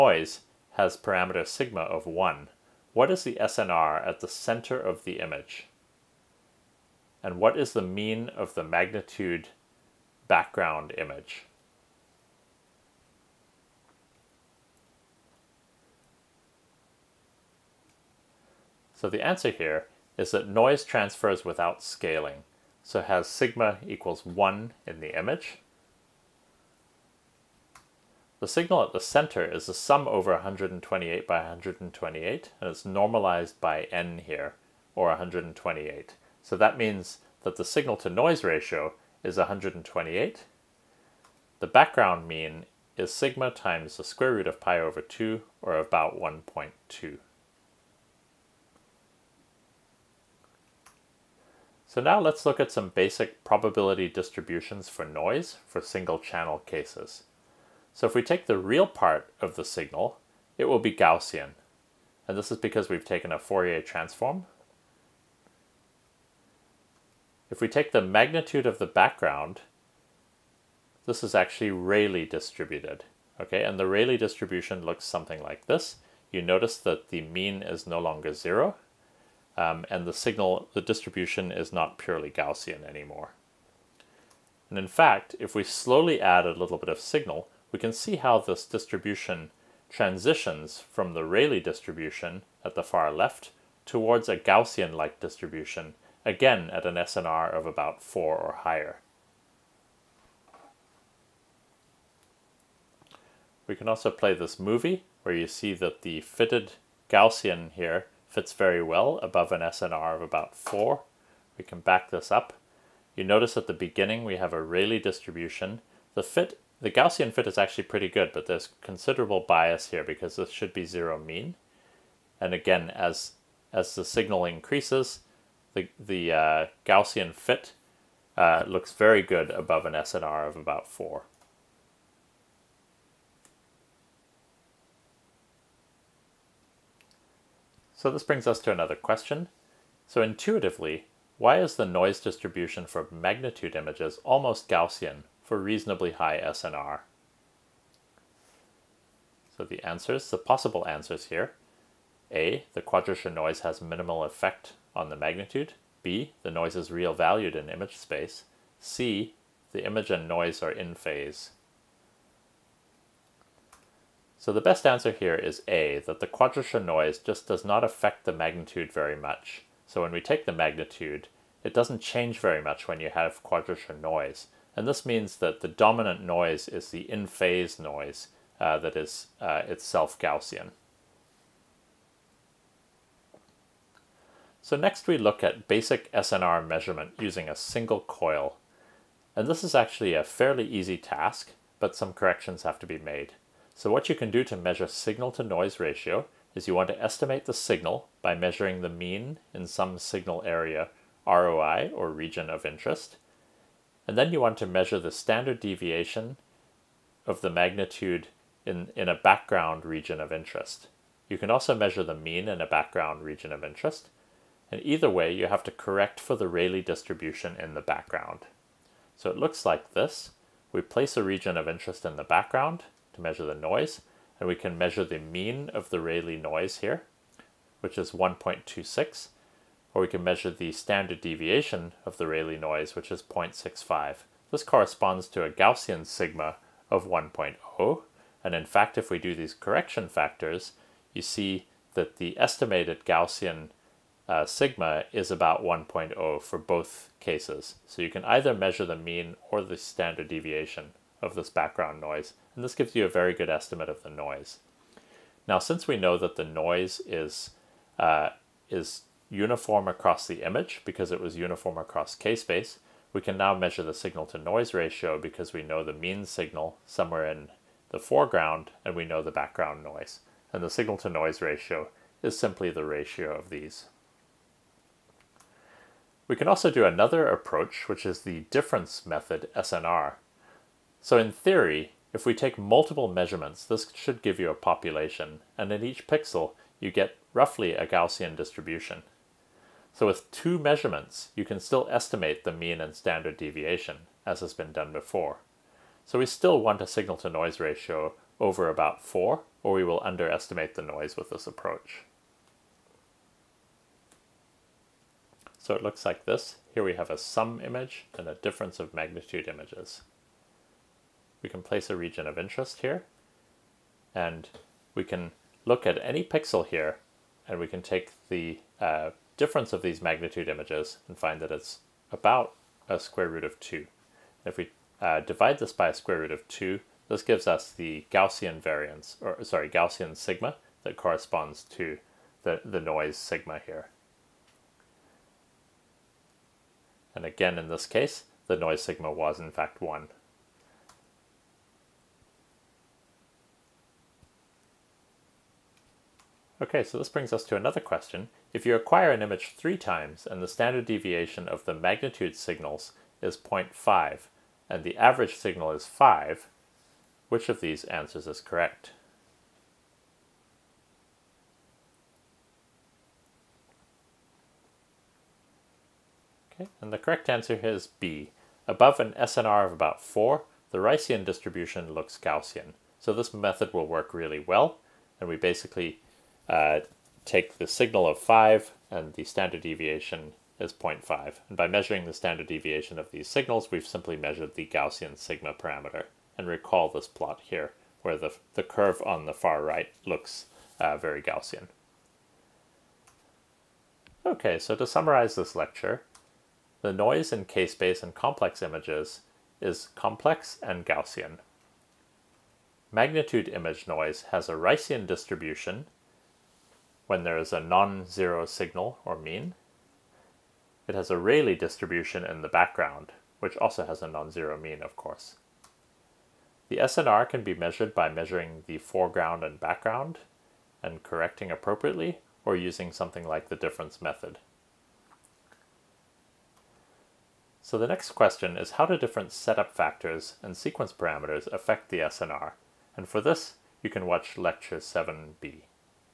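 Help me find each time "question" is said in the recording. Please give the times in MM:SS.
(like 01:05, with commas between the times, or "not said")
02:18, 05:47, 07:08.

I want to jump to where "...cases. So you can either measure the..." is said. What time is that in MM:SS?
04:07.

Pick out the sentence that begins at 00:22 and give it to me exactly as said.
So has sigma equals 1 in the image.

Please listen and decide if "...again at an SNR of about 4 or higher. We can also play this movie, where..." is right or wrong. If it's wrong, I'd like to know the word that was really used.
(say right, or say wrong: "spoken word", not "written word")
right.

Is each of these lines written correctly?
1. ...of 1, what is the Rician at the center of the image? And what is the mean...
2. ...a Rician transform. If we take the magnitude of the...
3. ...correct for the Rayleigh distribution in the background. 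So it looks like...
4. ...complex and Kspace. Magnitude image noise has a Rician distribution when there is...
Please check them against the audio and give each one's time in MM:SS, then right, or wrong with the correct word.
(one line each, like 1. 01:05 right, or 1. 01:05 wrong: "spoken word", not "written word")
1. 00:01 wrong: "SNR", not "Rician"
2. 01:03 wrong: "Fourier", not "Rician"
3. 03:35 right
4. 06:39 wrong: "Gaussian", not "Kspace".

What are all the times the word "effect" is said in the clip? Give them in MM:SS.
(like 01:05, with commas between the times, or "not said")
02:34.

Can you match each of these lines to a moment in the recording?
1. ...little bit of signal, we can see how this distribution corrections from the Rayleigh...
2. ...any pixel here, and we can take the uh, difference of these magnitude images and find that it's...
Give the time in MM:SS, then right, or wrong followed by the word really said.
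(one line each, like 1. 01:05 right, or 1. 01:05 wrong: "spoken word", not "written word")
1. 01:26 wrong: "transitions", not "corrections"
2. 05:16 right.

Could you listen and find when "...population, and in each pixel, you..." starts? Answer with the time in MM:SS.
04:44.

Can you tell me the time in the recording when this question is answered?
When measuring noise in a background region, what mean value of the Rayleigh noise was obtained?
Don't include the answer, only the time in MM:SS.
03:48.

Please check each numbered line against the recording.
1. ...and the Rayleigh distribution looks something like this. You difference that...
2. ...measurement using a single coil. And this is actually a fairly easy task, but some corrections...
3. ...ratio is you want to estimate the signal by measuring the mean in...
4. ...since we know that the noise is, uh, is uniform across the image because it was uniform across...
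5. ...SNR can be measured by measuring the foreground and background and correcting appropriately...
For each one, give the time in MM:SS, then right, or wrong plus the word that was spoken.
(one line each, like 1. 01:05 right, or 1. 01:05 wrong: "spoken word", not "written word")
1. 01:13 wrong: "notice", not "difference"
2. 03:06 right
3. 03:15 right
4. 04:15 right
5. 06:56 right.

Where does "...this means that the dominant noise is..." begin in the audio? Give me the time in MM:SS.
02:54.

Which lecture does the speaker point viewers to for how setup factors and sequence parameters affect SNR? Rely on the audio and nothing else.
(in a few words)
lecture 7b.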